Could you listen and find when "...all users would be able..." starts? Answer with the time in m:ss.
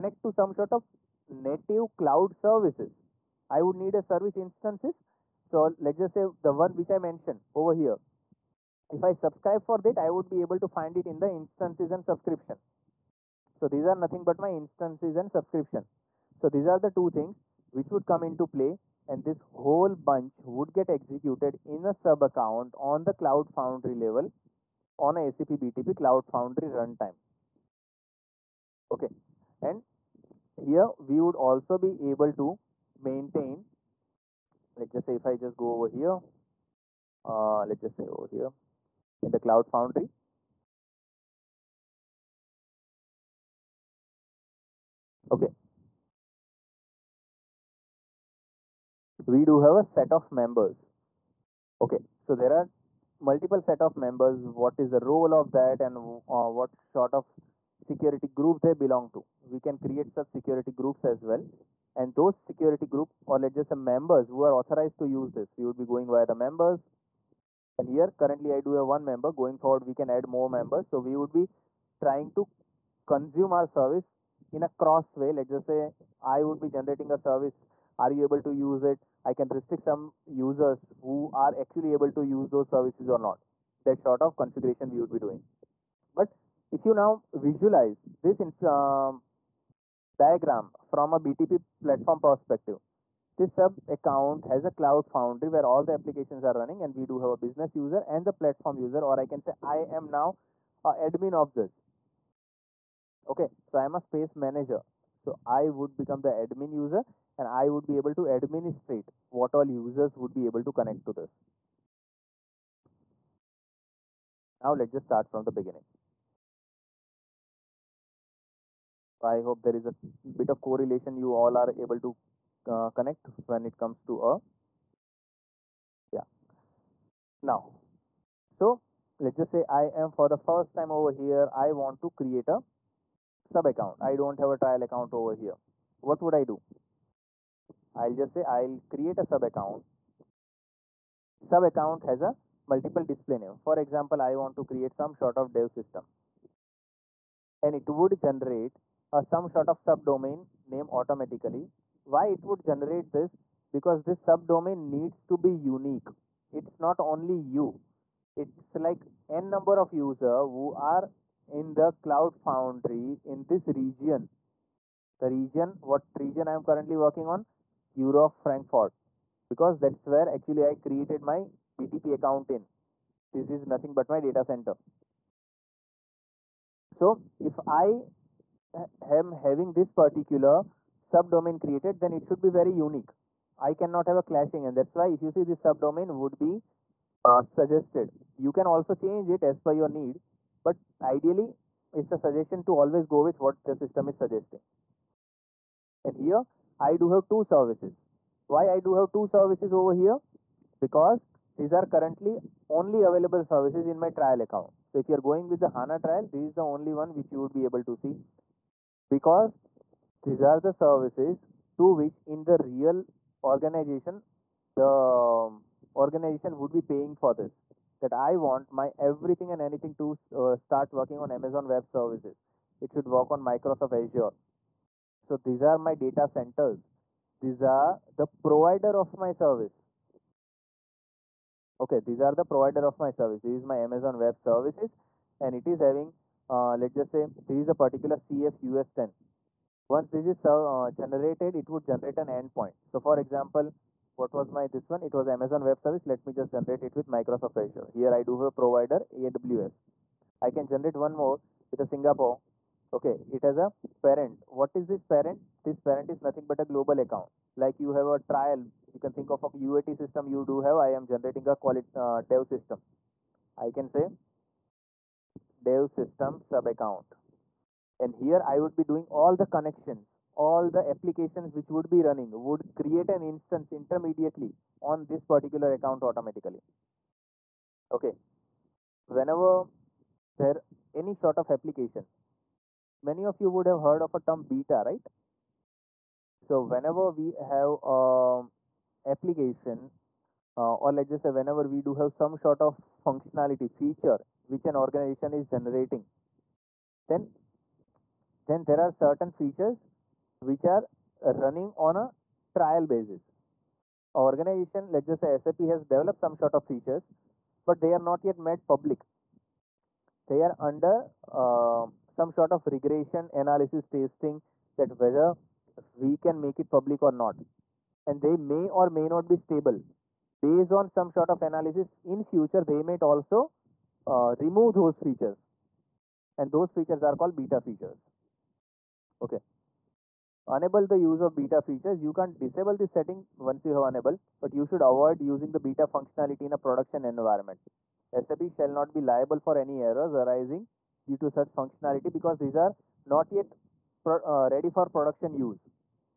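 1:49.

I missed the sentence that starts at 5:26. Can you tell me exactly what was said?
And those features are called beta features.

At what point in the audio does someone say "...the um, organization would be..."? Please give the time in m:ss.
3:34.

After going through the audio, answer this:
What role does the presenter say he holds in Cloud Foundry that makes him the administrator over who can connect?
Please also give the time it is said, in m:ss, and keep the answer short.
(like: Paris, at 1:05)
Space manager, at 1:44.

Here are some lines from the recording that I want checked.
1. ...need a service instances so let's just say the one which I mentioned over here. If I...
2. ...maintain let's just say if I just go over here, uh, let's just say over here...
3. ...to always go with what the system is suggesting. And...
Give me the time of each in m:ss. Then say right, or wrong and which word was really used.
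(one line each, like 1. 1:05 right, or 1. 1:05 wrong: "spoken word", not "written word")
1. 0:03 right
2. 0:33 right
3. 3:12 right.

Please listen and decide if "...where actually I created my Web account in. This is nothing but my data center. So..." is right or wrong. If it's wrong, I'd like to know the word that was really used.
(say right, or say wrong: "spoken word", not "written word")
wrong: "BTP", not "Web".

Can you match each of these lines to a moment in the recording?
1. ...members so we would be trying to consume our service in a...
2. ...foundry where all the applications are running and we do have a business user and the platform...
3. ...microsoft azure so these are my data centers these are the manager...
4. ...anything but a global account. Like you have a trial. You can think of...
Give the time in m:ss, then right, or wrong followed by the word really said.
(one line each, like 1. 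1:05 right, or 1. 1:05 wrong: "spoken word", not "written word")
1. 1:10 right
2. 1:35 right
3. 3:43 wrong: "provider", not "manager"
4. 4:16 wrong: "nothing", not "anything".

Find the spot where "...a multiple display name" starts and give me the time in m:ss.
2:22.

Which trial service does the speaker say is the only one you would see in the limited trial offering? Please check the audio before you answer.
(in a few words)
HANA trial.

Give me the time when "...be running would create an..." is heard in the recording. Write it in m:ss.
4:31.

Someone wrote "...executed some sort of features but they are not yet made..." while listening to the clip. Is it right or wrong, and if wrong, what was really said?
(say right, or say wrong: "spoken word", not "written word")
wrong: "developed", not "executed".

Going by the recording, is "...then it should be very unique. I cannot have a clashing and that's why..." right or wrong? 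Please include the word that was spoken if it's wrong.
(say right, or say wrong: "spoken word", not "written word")
right.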